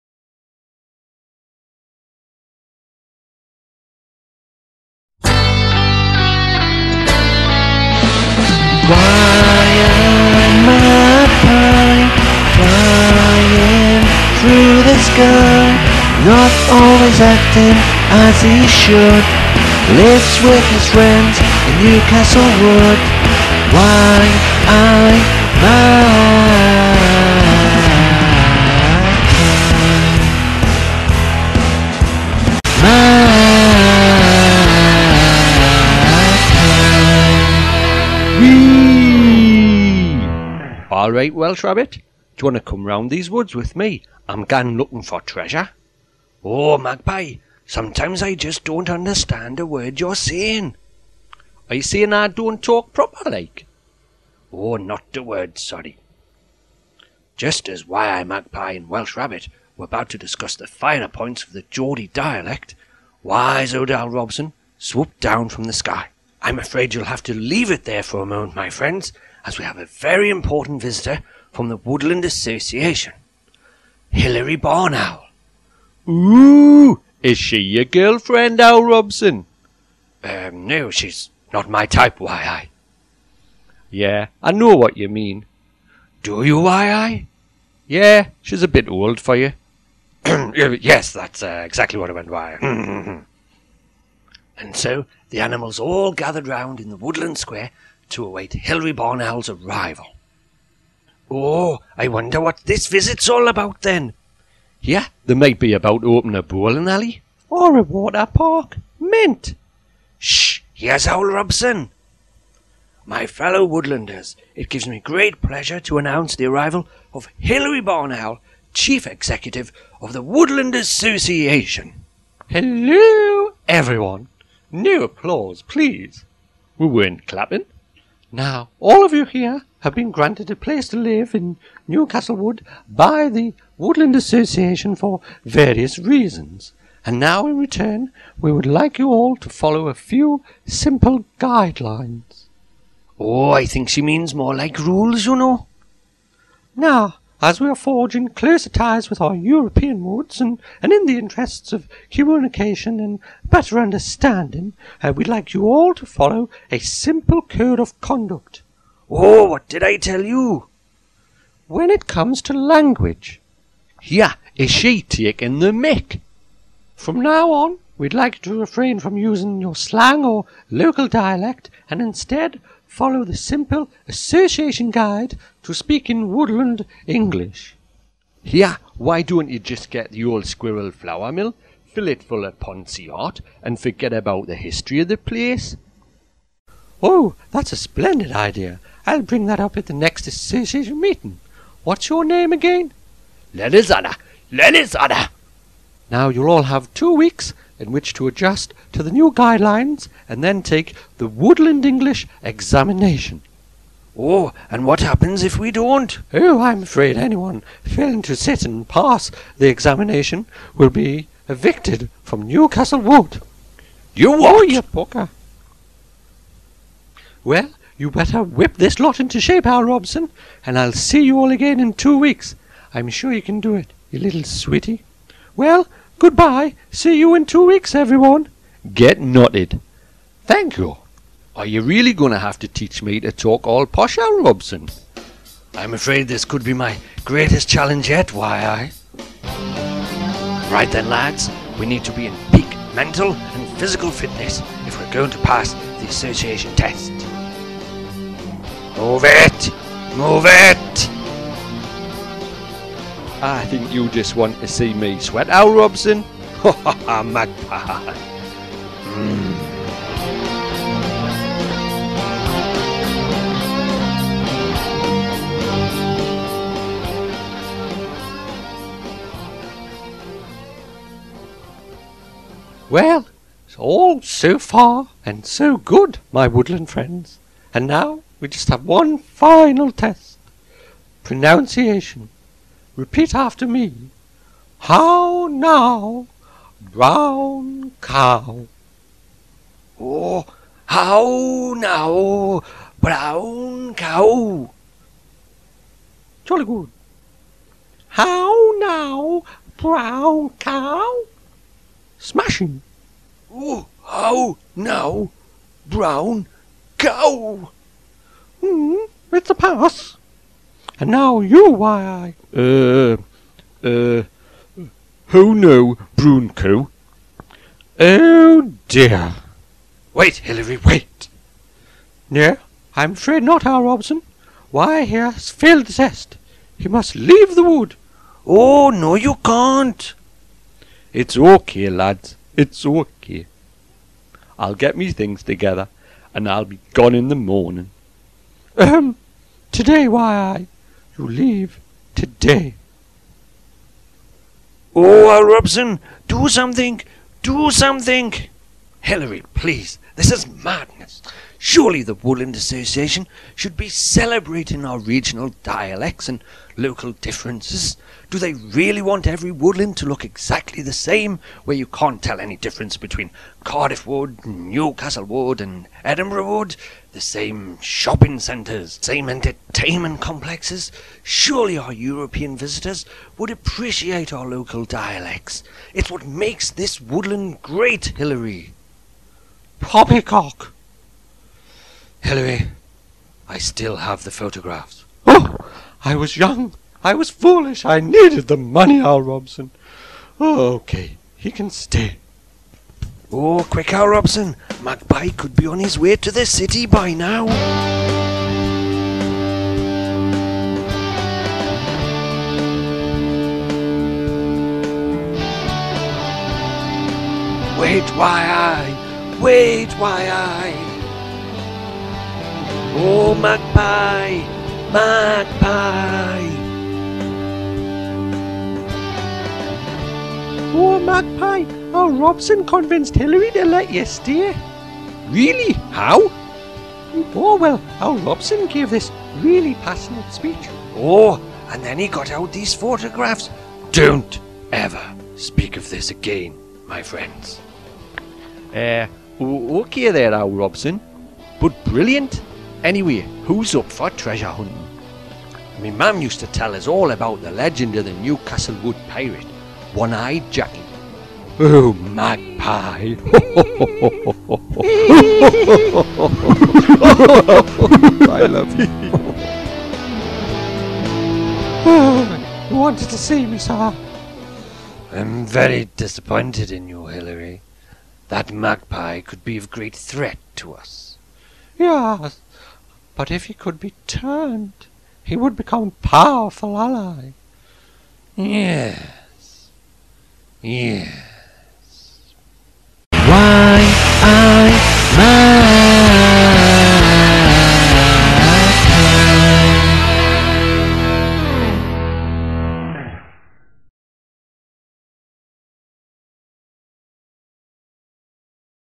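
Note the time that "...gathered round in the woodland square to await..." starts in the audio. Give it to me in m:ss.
1:36.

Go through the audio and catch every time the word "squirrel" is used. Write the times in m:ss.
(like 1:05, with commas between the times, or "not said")
3:00.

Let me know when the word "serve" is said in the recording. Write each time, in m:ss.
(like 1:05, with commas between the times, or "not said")
not said.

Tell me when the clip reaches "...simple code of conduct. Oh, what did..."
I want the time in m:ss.
2:36.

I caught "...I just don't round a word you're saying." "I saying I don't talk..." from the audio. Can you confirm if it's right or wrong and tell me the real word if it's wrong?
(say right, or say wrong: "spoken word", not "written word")
wrong: "understand", not "round".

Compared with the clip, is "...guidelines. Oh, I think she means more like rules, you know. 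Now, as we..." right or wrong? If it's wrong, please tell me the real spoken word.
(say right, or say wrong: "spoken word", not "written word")
right.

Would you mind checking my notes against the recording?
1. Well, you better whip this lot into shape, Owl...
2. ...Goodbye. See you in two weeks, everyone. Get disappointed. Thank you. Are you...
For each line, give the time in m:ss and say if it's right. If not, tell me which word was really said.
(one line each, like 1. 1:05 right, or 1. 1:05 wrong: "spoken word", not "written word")
1. 3:37 right
2. 3:46 wrong: "nutted", not "disappointed".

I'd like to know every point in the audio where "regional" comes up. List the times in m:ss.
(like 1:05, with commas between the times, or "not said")
5:54.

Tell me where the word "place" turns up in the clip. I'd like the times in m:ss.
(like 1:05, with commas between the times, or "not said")
2:10, 3:05.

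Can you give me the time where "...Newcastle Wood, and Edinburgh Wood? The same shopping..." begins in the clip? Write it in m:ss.
6:04.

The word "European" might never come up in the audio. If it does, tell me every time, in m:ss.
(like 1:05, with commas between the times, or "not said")
2:29, 6:11.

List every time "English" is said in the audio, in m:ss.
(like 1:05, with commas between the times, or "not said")
2:57, 3:21.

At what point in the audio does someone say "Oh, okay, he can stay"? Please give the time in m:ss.
6:30.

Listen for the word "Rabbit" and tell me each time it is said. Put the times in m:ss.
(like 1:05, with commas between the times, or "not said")
0:41, 0:59.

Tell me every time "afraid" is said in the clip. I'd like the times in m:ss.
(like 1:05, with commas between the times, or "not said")
1:06, 3:26, 3:55, 5:23.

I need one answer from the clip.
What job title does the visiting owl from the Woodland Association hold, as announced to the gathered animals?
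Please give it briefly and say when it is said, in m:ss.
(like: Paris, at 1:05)
Chief Executive, at 1:58.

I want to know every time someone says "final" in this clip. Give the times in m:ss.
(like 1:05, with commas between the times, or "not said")
4:39.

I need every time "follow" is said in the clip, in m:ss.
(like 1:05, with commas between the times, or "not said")
2:19, 2:36, 2:52.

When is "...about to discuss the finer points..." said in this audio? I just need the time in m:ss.
0:59.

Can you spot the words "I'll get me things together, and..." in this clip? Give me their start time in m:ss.
5:34.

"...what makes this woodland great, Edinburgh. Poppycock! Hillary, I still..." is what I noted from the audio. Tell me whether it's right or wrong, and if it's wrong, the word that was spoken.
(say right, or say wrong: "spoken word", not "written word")
wrong: "Hilary", not "Edinburgh".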